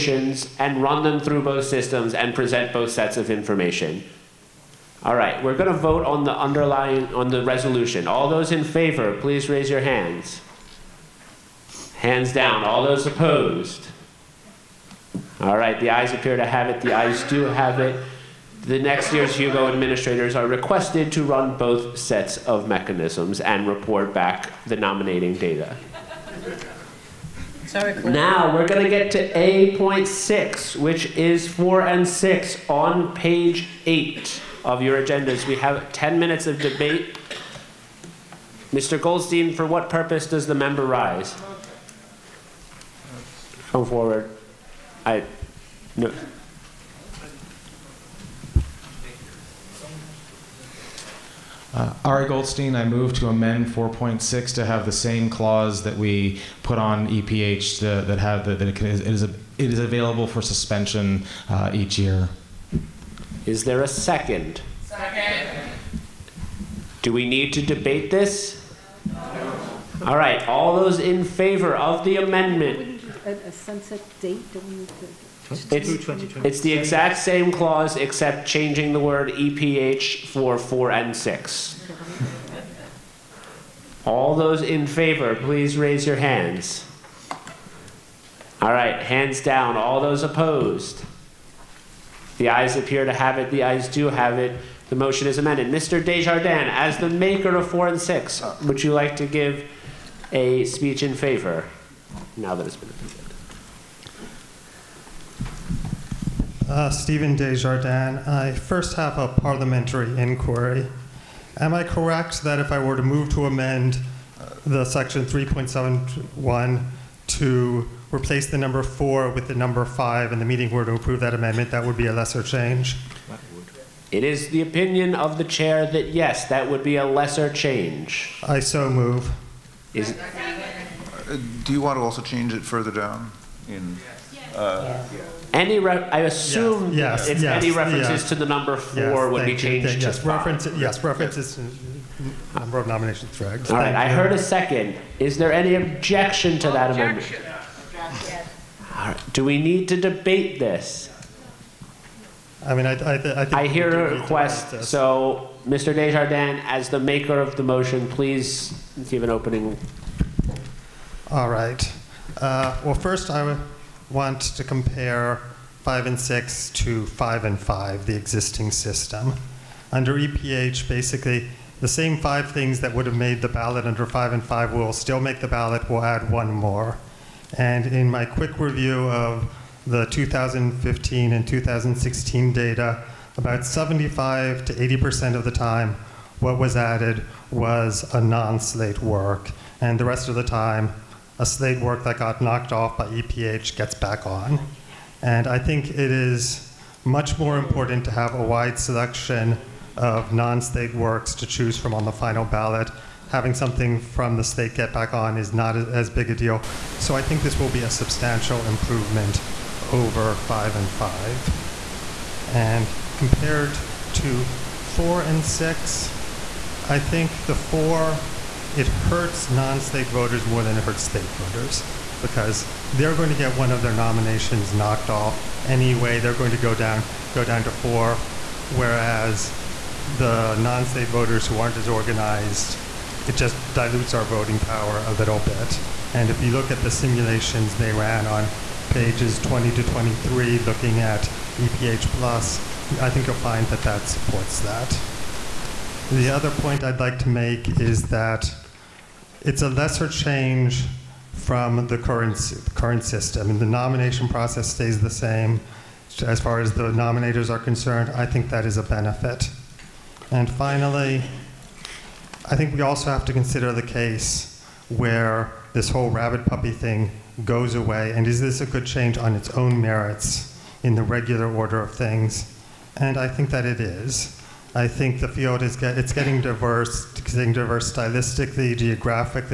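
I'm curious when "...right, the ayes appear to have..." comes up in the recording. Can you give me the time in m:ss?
0:15.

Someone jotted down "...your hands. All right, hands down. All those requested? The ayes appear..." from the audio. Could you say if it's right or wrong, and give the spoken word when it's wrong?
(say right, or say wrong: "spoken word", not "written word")
wrong: "opposed", not "requested".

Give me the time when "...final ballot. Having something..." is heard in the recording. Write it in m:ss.
3:22.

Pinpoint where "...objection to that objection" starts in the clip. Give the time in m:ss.
2:25.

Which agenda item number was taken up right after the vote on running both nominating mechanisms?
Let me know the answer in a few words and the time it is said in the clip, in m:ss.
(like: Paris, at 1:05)
A.6, at 0:29.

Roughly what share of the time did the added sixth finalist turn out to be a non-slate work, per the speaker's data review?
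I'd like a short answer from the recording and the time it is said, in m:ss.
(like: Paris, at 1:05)
75 to 80%, at 3:03.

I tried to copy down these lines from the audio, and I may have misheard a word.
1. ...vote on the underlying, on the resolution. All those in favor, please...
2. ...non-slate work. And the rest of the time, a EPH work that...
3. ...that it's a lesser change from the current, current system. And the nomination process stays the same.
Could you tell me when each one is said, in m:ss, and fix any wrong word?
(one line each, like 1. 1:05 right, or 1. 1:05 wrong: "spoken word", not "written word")
1. 0:05 right
2. 3:08 wrong: "SLATE", not "EPH"
3. 4:08 right.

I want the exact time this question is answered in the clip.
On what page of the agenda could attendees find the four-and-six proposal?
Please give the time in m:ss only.
0:33.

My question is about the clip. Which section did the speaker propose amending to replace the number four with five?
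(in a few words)
3.71.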